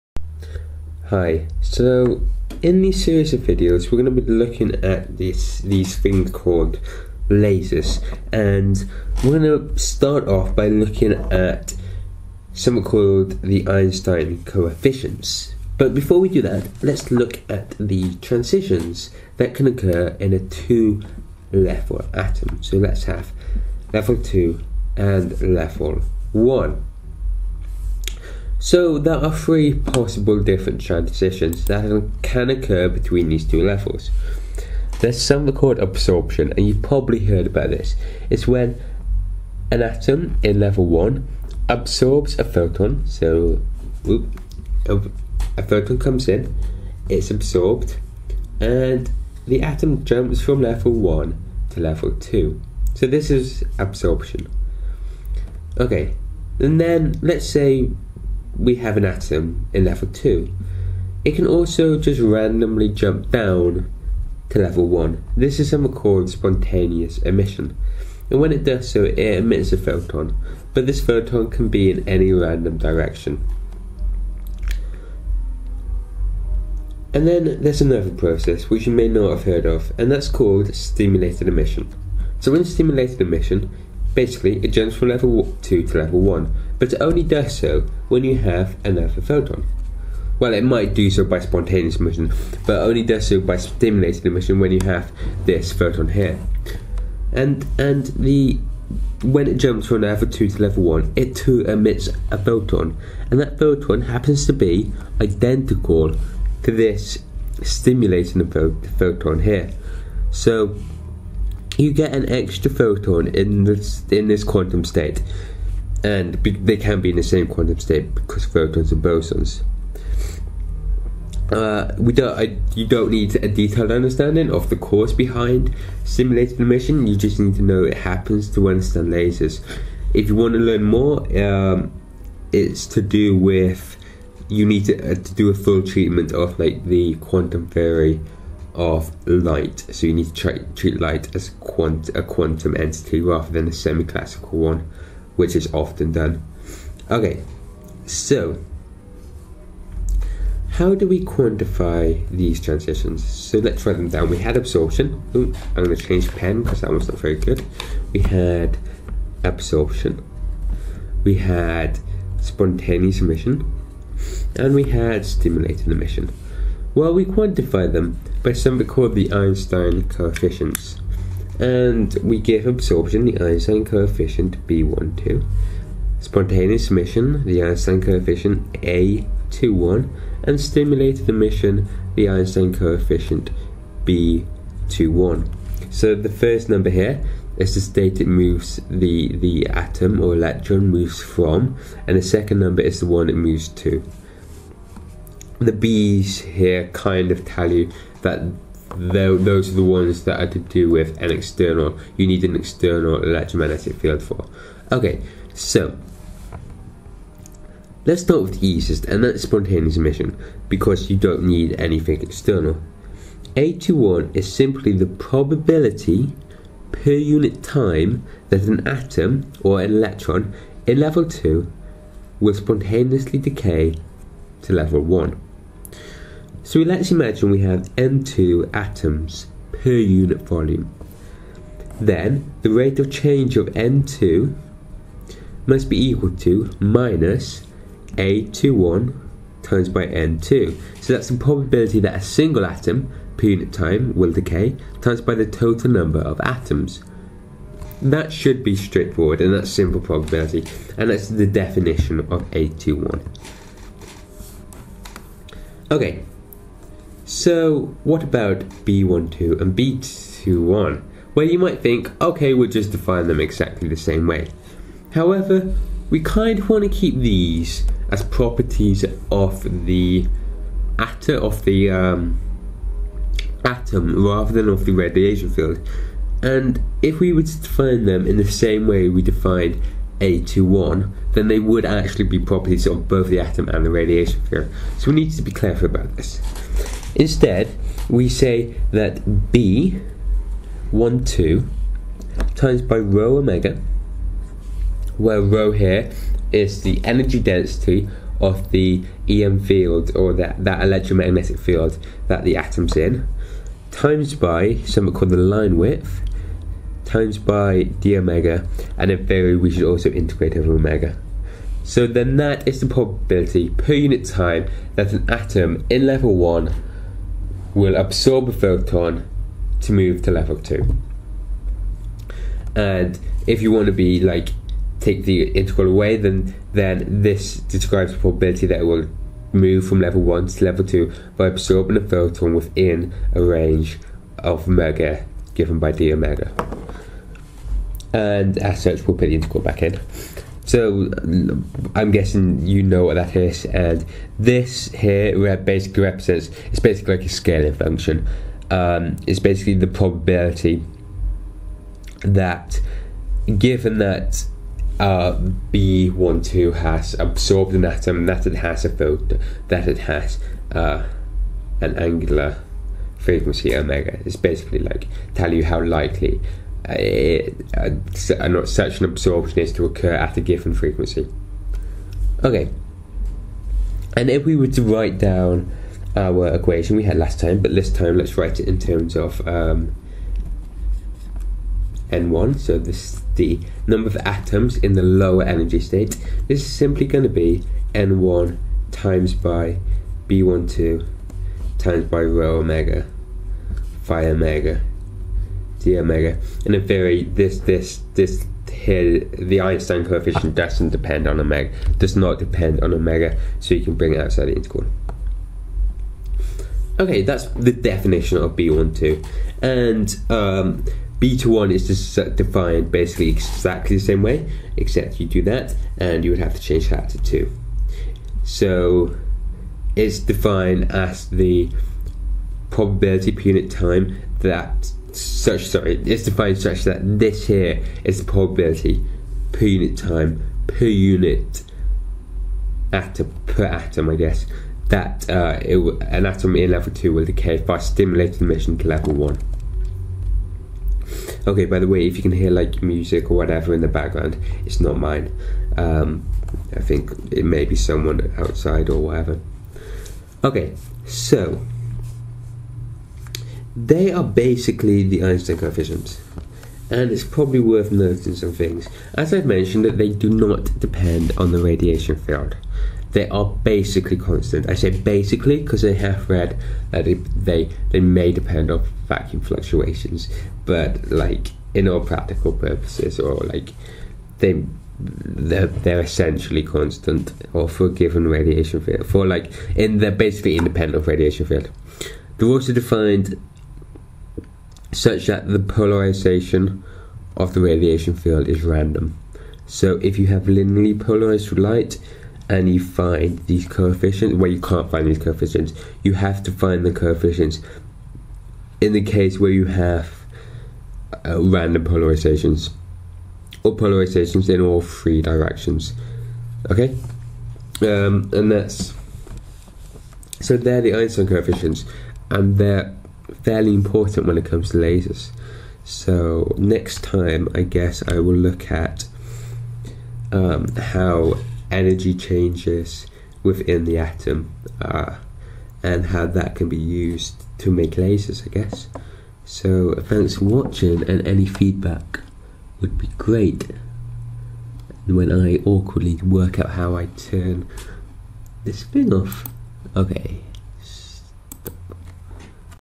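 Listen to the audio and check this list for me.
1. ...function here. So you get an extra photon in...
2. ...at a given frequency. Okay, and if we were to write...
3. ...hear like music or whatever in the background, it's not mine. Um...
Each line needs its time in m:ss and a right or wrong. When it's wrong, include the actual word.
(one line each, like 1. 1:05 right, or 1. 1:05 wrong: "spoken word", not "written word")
1. 1:48 wrong: "photon", not "function"
2. 6:10 right
3. 7:22 right.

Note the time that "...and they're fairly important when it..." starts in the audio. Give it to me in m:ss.
8:32.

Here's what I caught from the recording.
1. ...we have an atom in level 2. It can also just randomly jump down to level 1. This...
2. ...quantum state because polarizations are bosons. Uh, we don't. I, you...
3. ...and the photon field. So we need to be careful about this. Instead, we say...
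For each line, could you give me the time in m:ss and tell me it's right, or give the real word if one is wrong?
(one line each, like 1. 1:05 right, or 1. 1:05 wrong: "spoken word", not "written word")
1. 0:58 right
2. 1:57 wrong: "photons", not "polarizations"
3. 4:43 wrong: "radiation", not "photon".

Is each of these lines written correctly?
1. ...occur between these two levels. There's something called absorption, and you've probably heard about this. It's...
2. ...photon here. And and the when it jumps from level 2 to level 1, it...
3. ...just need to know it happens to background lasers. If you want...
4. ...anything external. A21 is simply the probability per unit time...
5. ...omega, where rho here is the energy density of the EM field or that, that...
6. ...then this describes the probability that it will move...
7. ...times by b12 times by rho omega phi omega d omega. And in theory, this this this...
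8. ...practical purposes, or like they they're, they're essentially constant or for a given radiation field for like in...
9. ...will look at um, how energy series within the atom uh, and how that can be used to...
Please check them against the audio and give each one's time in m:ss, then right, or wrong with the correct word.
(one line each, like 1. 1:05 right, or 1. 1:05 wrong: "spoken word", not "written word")
1. 0:32 right
2. 1:35 right
3. 2:07 wrong: "understand", not "background"
4. 3:31 right
5. 4:53 right
6. 5:26 right
7. 6:28 right
8. 7:52 right
9. 8:38 wrong: "changes", not "series".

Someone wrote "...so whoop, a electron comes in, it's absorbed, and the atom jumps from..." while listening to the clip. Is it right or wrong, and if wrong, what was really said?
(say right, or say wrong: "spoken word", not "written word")
wrong: "photon", not "electron".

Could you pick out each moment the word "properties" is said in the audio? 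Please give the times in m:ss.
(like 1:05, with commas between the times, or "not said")
4:28, 4:42.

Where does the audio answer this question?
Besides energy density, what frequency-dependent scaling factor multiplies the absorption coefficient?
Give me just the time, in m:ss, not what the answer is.
5:05.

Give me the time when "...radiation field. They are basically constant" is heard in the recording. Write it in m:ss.
7:41.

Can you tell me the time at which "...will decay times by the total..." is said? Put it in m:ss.
4:04.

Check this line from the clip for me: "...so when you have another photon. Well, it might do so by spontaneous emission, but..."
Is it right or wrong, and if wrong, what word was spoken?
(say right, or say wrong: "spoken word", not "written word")
right.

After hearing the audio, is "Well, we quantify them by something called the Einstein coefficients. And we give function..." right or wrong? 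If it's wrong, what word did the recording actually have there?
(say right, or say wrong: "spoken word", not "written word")
wrong: "absorption", not "function".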